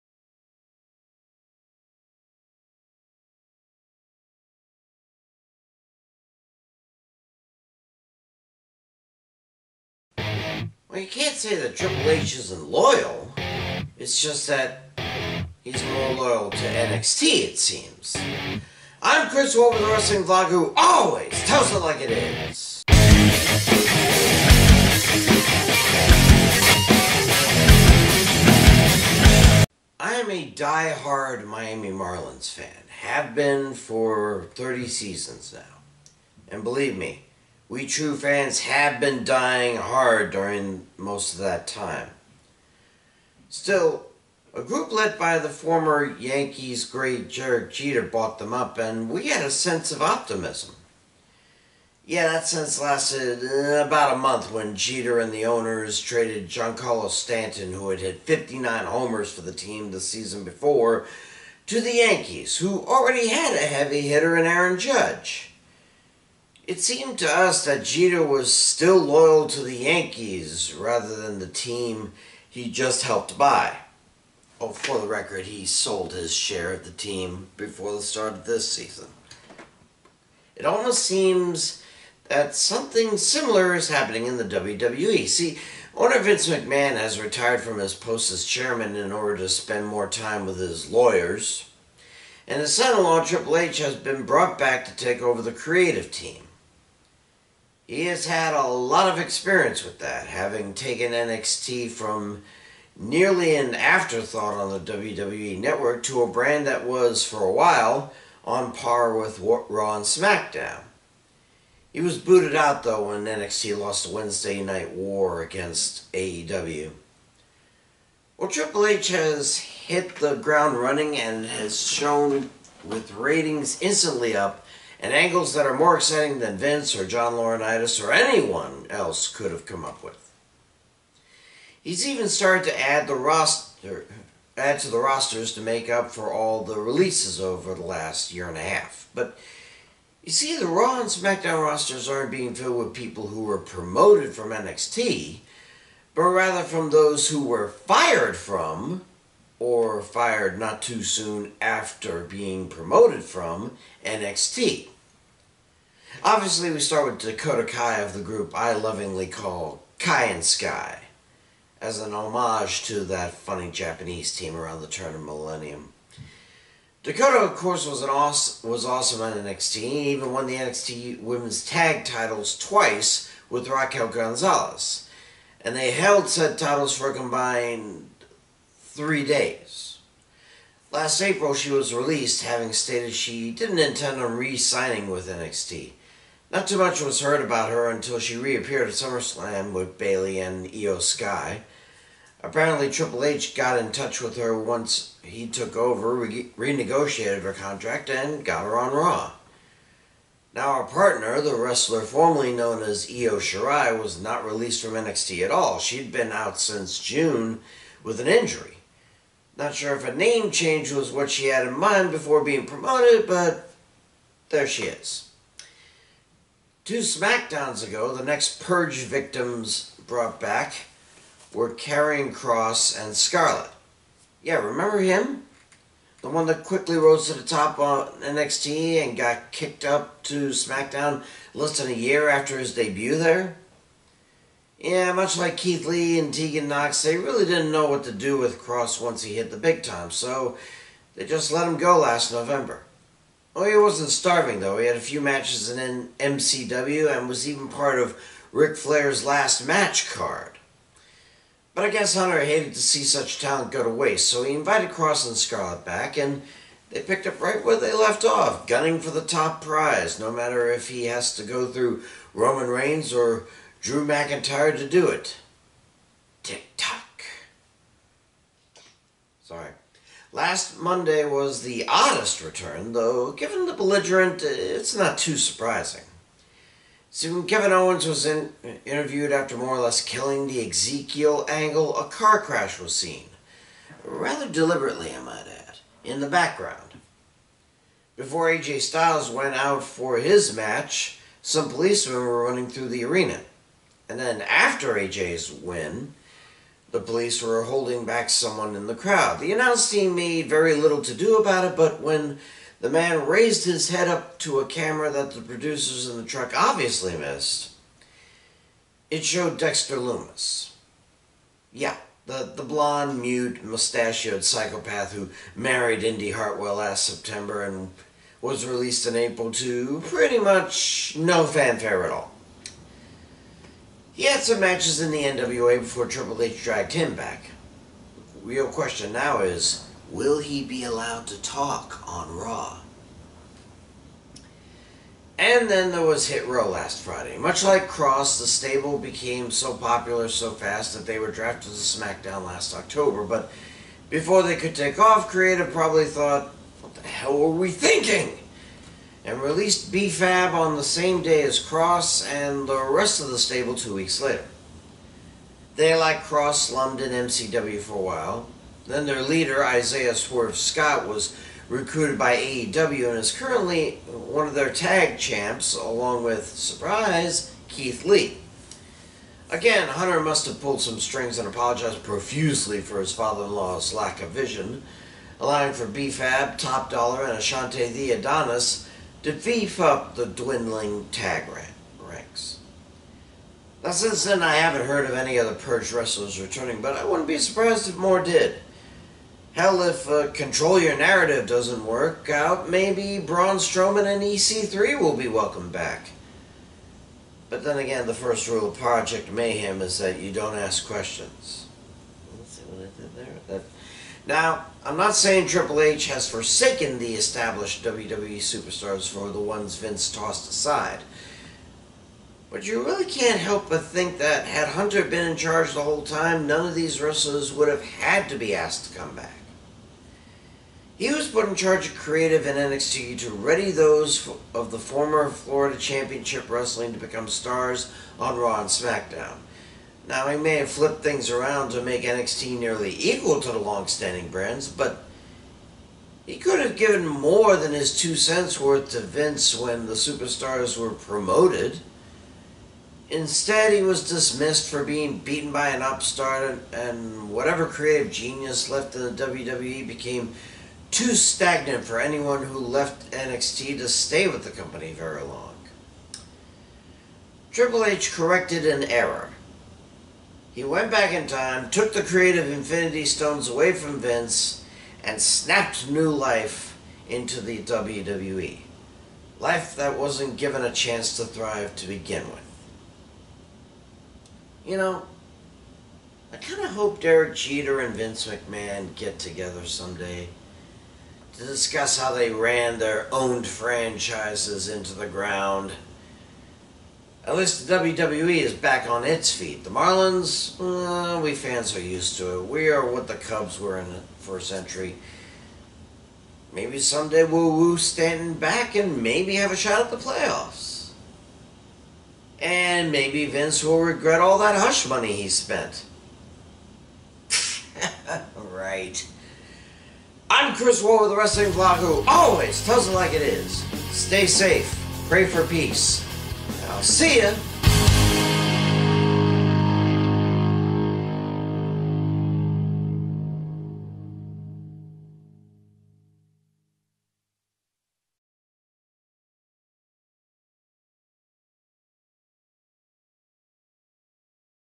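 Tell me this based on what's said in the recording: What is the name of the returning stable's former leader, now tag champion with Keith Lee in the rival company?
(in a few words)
Isaiah Swerve Scott.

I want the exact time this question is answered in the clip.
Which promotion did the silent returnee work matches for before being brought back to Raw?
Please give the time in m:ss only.
5:25.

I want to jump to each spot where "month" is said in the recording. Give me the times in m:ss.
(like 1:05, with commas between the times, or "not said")
0:54.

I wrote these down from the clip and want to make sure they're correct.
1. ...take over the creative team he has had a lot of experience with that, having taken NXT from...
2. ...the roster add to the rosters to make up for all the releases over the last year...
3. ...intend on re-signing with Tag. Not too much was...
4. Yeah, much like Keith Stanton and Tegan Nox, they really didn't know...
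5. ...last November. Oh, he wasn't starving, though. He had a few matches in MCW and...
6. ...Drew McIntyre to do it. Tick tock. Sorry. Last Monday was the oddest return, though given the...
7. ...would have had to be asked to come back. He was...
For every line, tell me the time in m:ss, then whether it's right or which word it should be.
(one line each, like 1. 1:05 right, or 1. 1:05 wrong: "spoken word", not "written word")
1. 1:34 right
2. 2:13 right
3. 3:03 wrong: "NXT", not "Tag"
4. 3:54 wrong: "Lee", not "Stanton"
5. 4:01 right
6. 4:23 right
7. 6:57 right.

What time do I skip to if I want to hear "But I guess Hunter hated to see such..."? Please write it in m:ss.
4:11.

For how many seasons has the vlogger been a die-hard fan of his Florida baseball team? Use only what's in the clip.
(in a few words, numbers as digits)
30.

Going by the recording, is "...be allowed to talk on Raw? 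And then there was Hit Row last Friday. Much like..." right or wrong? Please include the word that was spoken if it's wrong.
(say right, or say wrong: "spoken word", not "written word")
right.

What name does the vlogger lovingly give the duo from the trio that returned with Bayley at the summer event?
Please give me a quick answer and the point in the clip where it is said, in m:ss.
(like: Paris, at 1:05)
Kai and Sky, at 2:39.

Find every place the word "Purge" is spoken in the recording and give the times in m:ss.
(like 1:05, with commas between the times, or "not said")
3:38, 6:25.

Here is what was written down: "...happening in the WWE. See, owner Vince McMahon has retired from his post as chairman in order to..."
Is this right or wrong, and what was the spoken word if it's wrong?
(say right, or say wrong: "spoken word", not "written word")
right.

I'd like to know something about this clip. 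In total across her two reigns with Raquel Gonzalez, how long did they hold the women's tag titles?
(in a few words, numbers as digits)
3 days.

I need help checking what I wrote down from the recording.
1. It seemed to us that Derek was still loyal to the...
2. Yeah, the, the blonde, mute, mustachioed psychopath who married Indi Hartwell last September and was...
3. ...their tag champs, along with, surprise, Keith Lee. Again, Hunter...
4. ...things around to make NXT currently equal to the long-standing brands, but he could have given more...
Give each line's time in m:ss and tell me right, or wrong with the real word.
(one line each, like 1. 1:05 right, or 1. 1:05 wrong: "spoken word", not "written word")
1. 1:06 wrong: "Jeter", not "Derek"
2. 5:11 right
3. 6:04 right
4. 7:11 wrong: "nearly", not "currently".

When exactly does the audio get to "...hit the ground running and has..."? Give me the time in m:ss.
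1:59.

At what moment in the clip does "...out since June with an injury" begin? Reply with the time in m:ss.
3:26.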